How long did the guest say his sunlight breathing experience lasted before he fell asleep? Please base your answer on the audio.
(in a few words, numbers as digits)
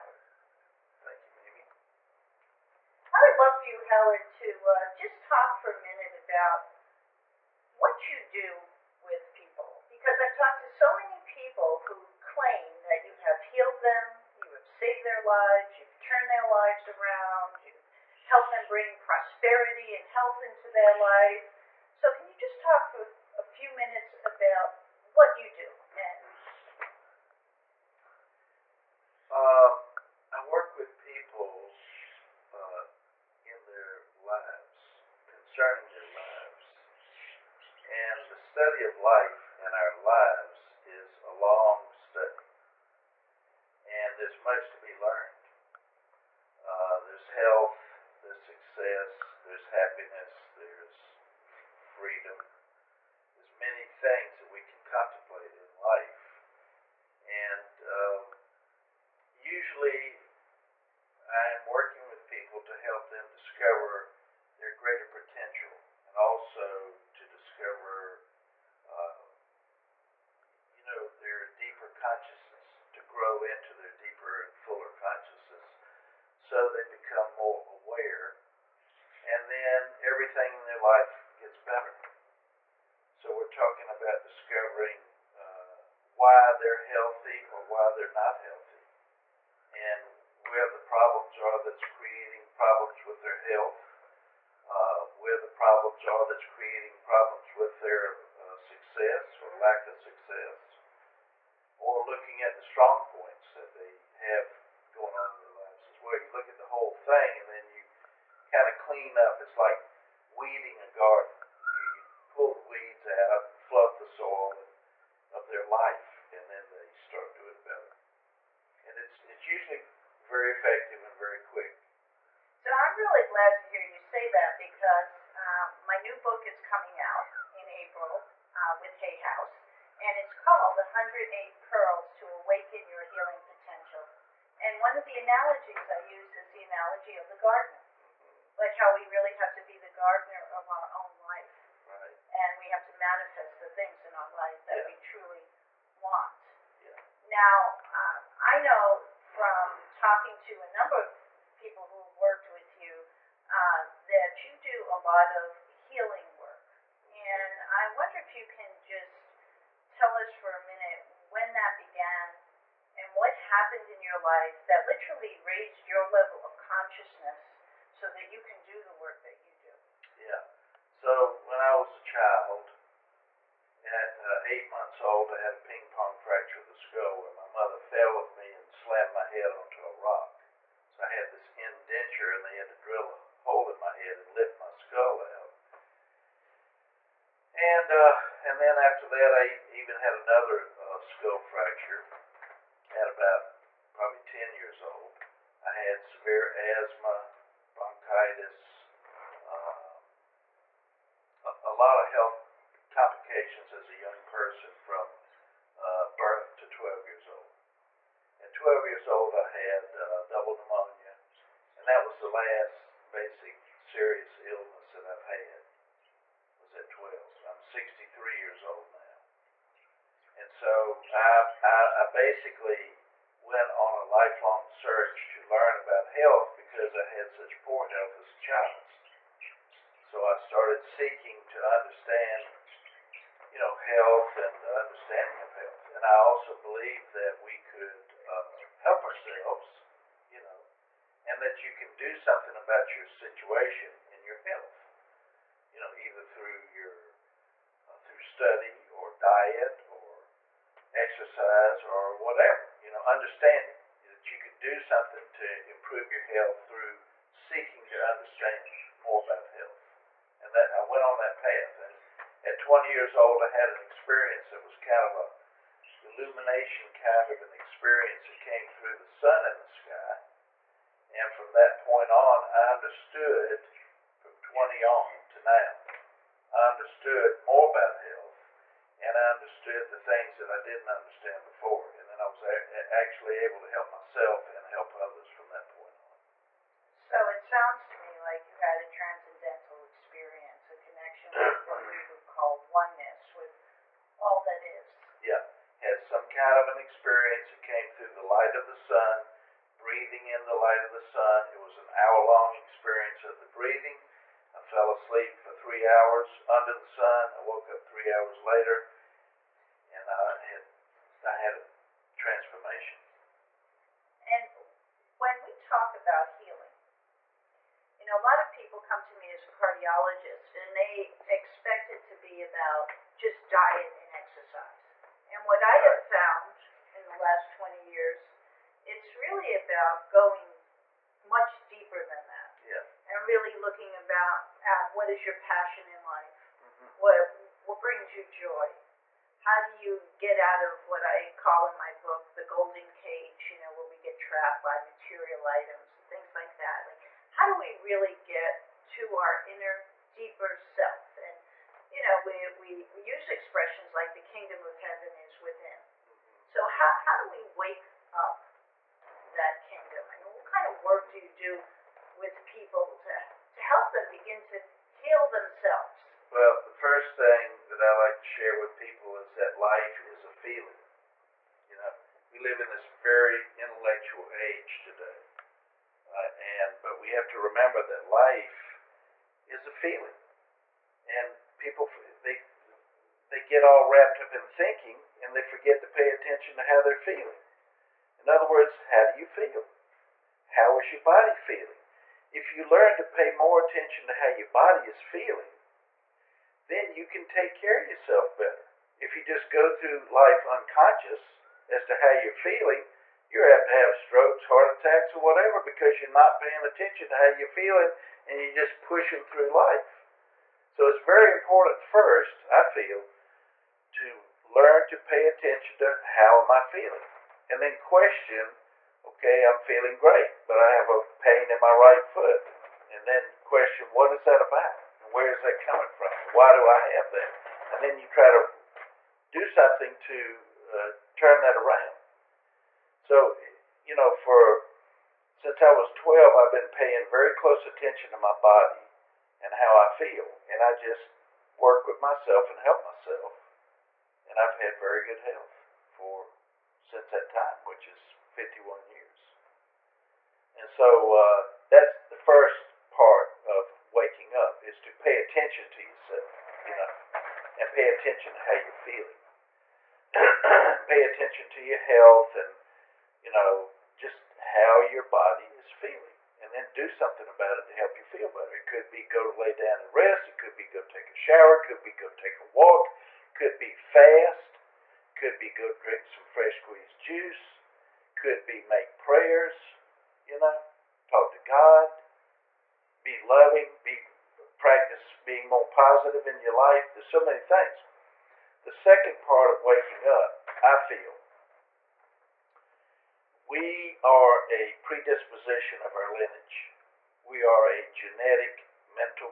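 An hour.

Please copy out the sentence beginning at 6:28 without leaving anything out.
In other words, how do you feel?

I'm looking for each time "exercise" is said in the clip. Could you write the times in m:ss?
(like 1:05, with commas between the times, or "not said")
4:10, 5:24.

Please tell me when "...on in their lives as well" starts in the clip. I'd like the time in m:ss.
1:45.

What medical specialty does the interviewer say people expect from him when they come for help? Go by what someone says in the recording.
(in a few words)
Cardiologist.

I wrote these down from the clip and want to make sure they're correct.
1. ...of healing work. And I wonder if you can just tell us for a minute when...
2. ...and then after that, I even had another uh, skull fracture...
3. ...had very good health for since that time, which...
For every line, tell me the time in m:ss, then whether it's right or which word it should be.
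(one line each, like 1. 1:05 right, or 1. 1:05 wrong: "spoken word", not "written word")
1. 2:35 right
2. 3:08 right
3. 7:24 right.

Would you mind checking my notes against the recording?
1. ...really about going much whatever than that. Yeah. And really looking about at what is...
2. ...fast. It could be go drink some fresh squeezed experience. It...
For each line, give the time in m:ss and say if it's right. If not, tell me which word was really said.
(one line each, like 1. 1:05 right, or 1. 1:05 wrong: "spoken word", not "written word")
1. 5:29 wrong: "deeper", not "whatever"
2. 7:53 wrong: "juice", not "experience".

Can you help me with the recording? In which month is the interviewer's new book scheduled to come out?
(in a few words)
April.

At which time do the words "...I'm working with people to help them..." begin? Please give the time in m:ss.
1:01.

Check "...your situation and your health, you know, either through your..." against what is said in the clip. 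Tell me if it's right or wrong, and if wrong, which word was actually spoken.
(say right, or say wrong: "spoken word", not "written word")
right.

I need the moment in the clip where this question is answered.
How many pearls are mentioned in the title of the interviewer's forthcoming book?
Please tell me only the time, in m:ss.
2:10.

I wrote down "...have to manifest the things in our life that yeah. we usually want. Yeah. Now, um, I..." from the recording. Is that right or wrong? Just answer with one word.
wrong.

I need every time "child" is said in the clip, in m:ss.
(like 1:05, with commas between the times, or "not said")
2:52, 3:48.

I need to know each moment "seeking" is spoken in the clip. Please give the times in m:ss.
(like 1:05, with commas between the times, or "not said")
3:50, 4:17.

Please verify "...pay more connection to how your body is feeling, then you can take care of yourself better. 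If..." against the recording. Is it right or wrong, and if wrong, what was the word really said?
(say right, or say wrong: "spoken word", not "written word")
wrong: "attention", not "connection".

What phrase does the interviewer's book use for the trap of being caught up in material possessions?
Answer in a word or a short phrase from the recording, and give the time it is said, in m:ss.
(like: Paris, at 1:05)
The golden cage, at 5:42.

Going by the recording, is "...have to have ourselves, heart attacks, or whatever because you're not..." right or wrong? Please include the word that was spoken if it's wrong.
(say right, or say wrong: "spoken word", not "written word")
wrong: "strokes", not "ourselves".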